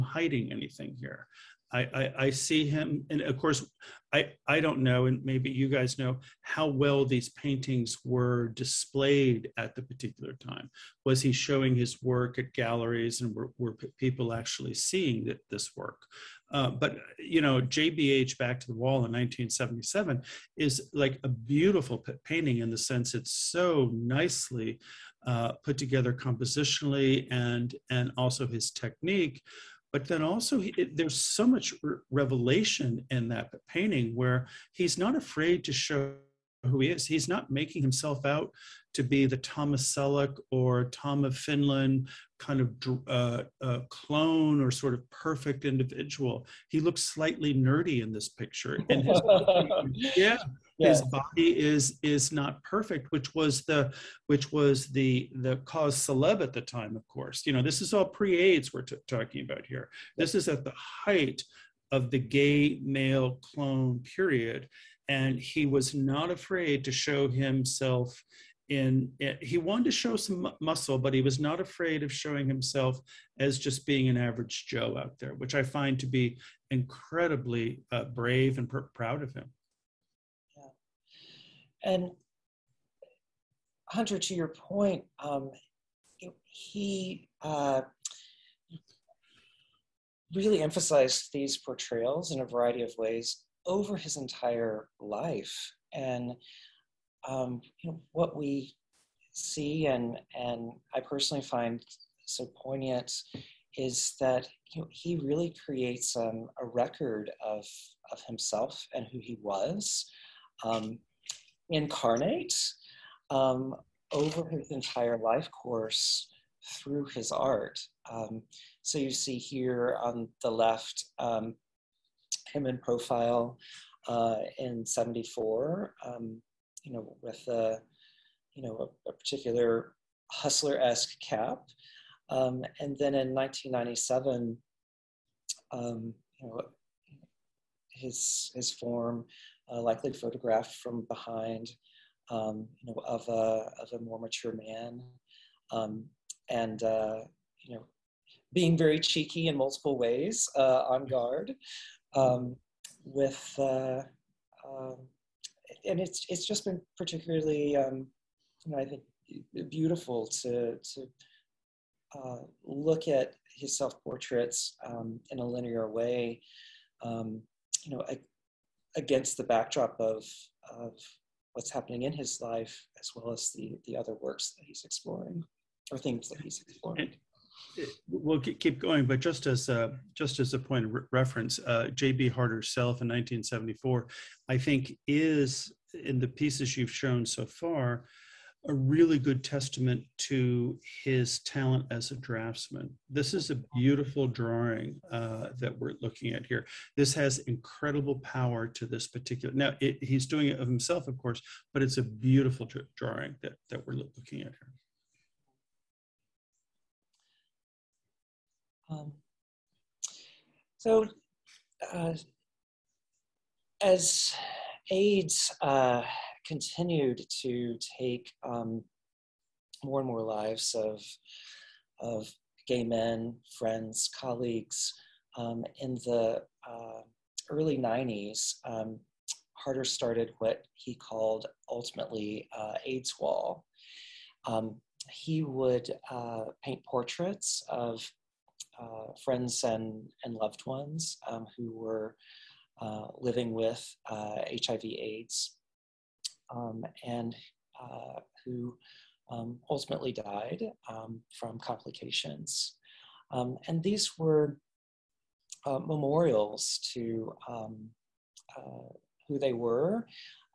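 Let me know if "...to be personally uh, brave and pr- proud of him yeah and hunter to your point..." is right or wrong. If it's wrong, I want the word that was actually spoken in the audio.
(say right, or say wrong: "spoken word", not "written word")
wrong: "incredibly", not "personally".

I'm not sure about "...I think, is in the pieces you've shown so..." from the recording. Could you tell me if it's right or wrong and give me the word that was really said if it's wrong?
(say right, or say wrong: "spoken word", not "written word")
right.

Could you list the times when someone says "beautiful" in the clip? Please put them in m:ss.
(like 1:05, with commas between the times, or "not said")
0:21, 2:39, 3:13, 3:22.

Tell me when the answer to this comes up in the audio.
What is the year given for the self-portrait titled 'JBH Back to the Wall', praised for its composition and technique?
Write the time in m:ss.
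0:19.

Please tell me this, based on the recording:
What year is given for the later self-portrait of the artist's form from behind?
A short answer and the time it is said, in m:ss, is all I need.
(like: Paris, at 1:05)
1997, at 2:13.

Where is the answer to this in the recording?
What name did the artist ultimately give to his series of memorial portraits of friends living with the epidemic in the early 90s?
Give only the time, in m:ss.
3:52.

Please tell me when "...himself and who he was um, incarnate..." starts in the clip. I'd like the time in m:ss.
1:48.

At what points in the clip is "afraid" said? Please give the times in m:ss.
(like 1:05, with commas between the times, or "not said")
0:35, 1:06, 1:11.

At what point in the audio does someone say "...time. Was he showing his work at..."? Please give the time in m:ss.
0:10.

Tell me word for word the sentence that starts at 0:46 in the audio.
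He looks slightly nerdy in this picture.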